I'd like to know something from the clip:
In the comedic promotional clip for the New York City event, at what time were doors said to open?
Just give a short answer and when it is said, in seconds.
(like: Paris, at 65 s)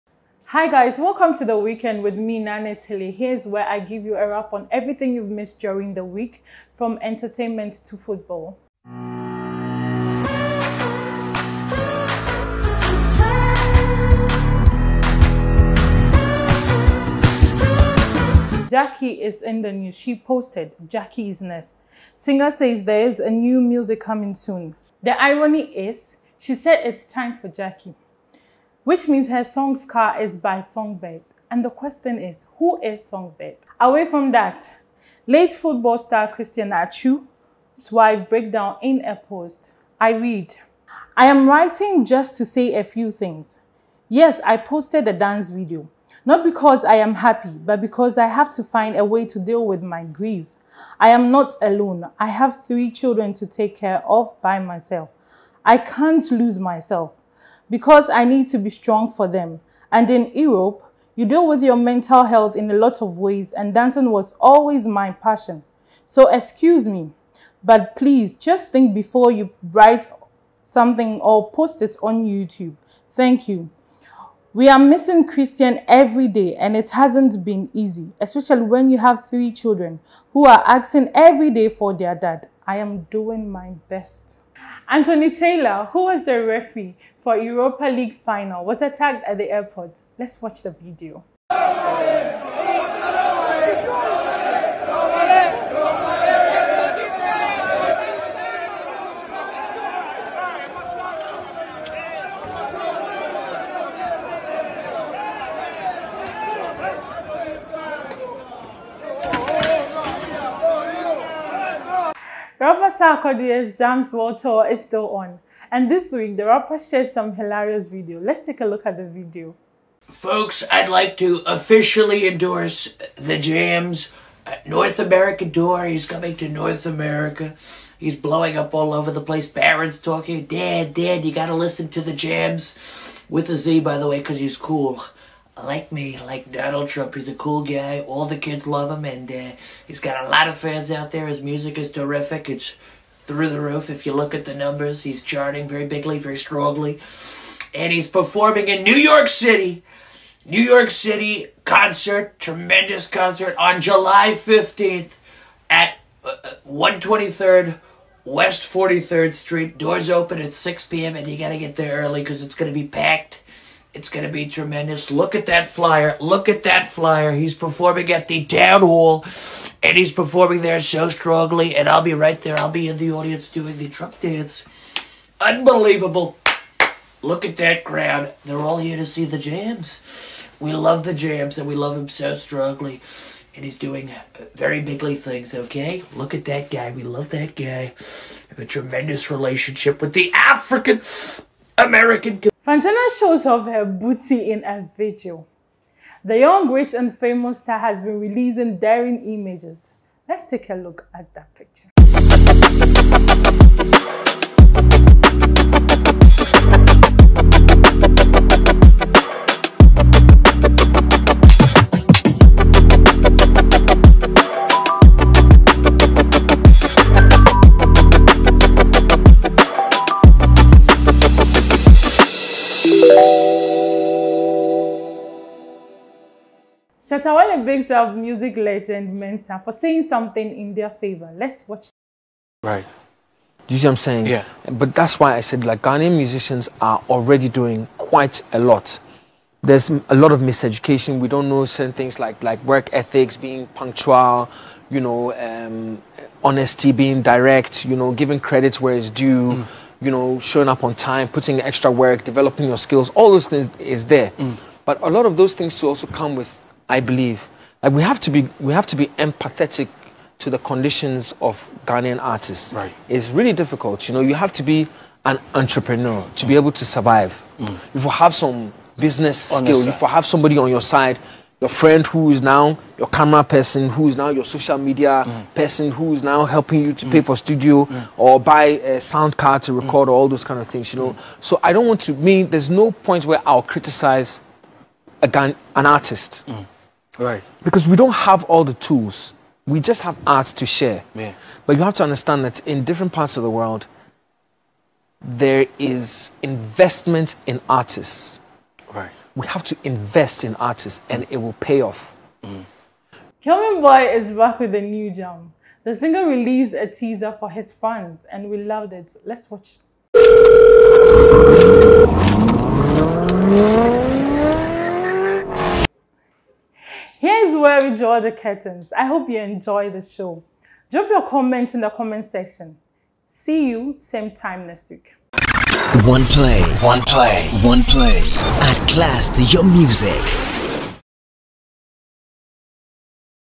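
6 p.m., at 160 s.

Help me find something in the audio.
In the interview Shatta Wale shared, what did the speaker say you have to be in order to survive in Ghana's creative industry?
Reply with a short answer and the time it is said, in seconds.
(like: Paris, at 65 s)
An entrepreneur, at 265 s.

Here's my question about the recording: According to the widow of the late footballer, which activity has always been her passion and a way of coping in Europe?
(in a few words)
Dancing.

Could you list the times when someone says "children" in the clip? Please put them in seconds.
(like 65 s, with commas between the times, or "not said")
52 s, 79 s.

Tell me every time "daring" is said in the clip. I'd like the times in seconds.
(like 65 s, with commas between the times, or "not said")
198 s.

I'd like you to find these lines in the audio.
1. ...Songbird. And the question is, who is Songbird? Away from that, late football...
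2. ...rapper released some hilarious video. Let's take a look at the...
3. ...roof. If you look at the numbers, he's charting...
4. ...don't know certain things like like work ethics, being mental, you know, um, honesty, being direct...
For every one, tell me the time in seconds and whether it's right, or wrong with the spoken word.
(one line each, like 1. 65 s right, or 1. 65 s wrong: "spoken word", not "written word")
1. 30 s right
2. 116 s wrong: "shared", not "released"
3. 143 s right
4. 241 s wrong: "punctual", not "mental".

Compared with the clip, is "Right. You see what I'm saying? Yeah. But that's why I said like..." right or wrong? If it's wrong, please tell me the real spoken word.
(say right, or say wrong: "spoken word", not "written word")
right.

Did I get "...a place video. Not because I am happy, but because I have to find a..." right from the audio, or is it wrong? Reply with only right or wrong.
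wrong.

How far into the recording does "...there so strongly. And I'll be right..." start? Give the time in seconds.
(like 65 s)
170 s.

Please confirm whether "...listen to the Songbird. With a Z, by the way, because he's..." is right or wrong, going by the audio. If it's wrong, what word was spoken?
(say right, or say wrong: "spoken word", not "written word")
wrong: "Jamz", not "Songbird".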